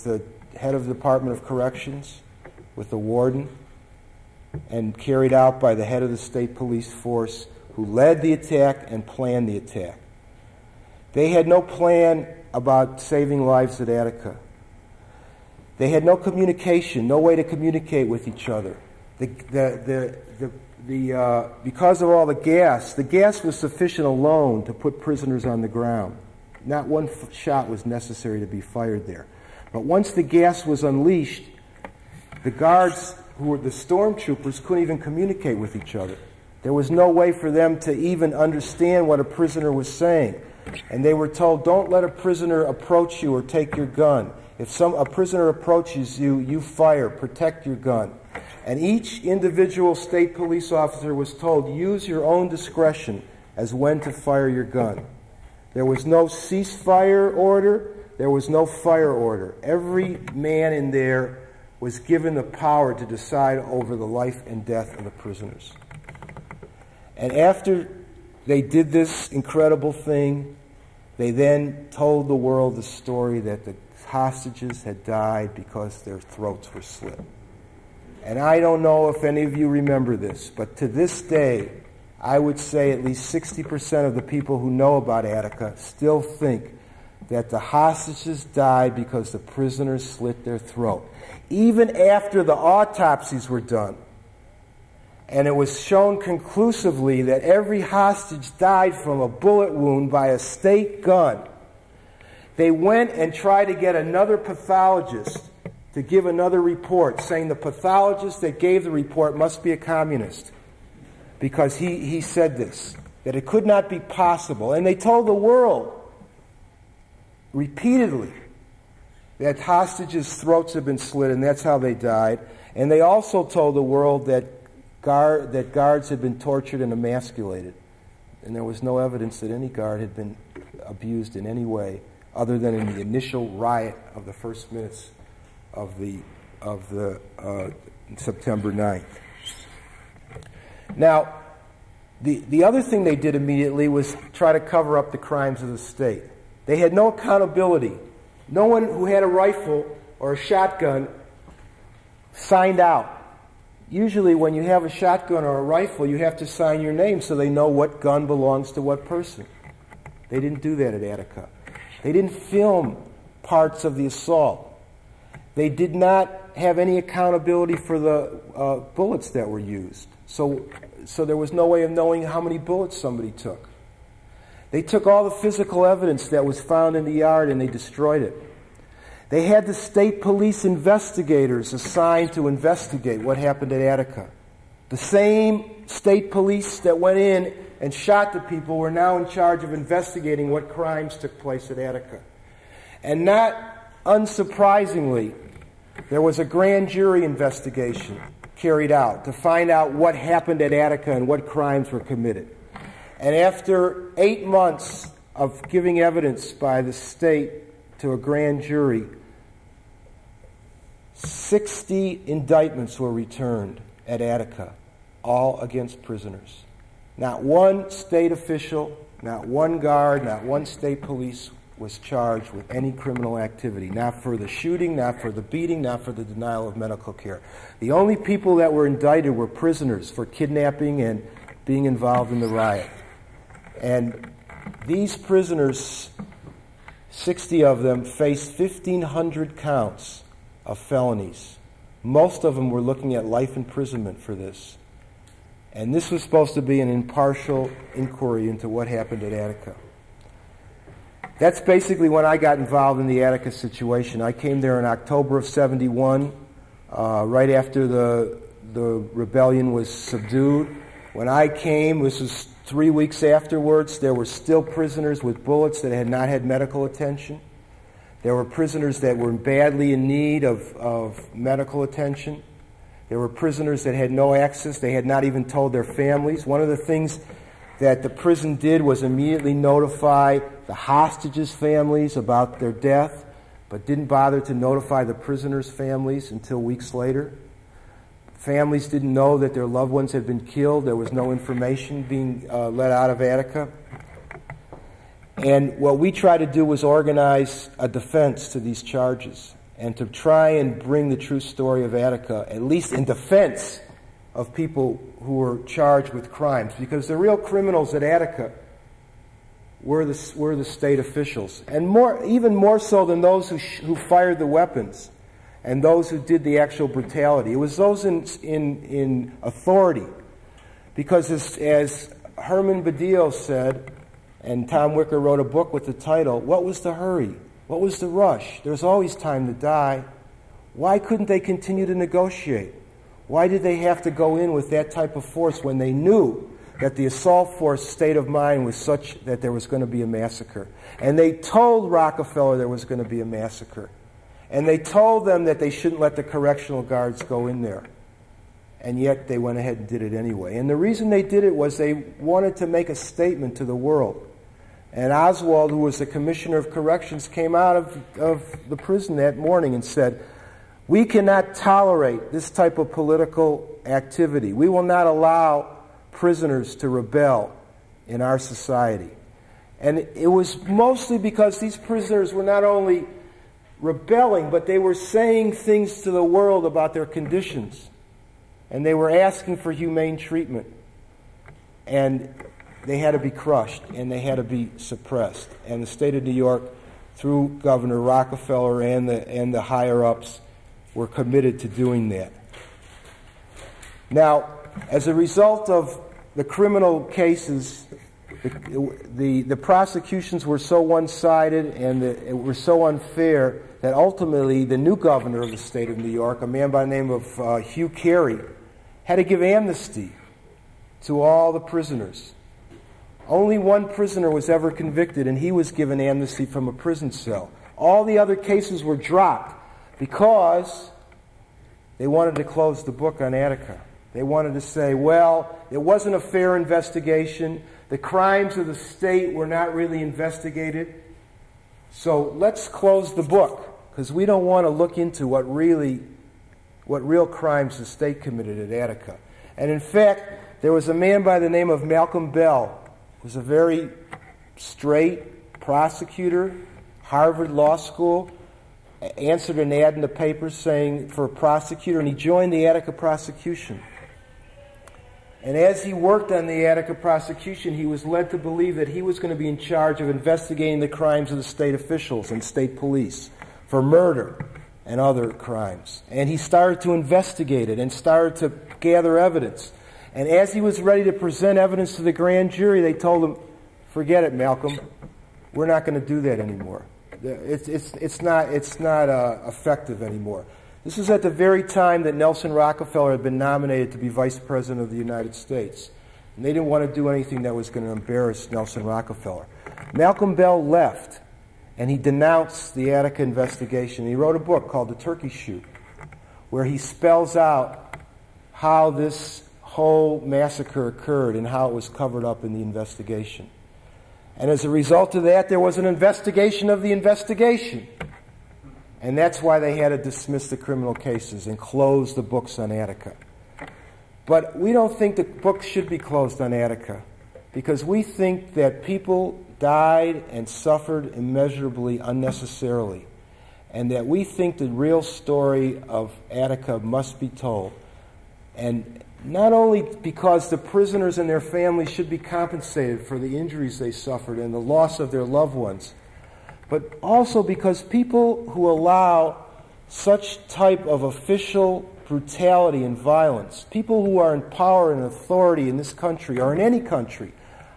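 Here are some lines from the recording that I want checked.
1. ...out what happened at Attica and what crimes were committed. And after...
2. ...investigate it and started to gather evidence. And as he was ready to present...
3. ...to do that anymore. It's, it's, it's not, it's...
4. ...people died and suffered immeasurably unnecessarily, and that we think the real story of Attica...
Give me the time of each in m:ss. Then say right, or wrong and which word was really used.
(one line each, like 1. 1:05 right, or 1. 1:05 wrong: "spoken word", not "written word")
1. 3:19 right
2. 7:46 right
3. 7:55 right
4. 8:38 right.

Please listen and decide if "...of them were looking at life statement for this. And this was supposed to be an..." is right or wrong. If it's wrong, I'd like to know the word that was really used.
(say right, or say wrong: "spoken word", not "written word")
wrong: "imprisonment", not "statement".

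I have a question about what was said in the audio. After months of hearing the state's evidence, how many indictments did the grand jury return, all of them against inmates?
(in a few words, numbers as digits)
60.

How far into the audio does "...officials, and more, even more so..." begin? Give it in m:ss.
5:10.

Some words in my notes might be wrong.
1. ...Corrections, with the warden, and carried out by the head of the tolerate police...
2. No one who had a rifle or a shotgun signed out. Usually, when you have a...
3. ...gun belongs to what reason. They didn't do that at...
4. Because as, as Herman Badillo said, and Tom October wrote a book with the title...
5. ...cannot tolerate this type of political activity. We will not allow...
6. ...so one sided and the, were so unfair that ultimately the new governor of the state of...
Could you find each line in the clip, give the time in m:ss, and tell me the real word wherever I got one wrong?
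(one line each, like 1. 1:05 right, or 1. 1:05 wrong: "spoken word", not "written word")
1. 0:01 wrong: "state", not "tolerate"
2. 2:28 right
3. 2:37 wrong: "person", not "reason"
4. 5:20 wrong: "Wicker", not "October"
5. 6:01 right
6. 6:40 right.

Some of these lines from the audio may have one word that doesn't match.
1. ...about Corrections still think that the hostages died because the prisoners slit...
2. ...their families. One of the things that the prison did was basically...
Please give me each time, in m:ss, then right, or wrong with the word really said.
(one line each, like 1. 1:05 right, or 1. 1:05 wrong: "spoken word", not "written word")
1. 1:24 wrong: "Attica", not "Corrections"
2. 4:35 wrong: "immediately", not "basically".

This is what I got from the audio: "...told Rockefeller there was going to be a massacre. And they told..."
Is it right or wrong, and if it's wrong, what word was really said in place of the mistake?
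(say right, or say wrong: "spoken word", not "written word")
right.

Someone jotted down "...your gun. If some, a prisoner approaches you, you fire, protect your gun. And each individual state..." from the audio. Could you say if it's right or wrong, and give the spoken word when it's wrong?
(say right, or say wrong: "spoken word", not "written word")
right.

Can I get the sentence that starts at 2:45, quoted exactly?
They did not have any accountability for the uh, bullets that were used.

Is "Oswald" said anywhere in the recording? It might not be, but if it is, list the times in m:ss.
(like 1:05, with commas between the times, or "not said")
5:55.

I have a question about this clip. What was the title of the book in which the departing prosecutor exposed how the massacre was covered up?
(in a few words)
The Turkey Shoot.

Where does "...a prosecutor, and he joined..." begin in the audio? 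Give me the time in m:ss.
7:31.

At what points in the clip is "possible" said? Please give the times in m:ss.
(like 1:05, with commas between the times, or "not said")
1:53.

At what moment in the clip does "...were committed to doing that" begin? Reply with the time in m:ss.
6:30.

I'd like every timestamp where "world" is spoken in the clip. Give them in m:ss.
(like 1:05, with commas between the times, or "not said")
1:12, 1:55, 2:03, 5:53, 6:16.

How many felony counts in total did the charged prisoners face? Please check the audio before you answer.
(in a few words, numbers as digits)
1,500.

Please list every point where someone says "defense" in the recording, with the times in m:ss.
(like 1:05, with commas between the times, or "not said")
4:57, 5:03.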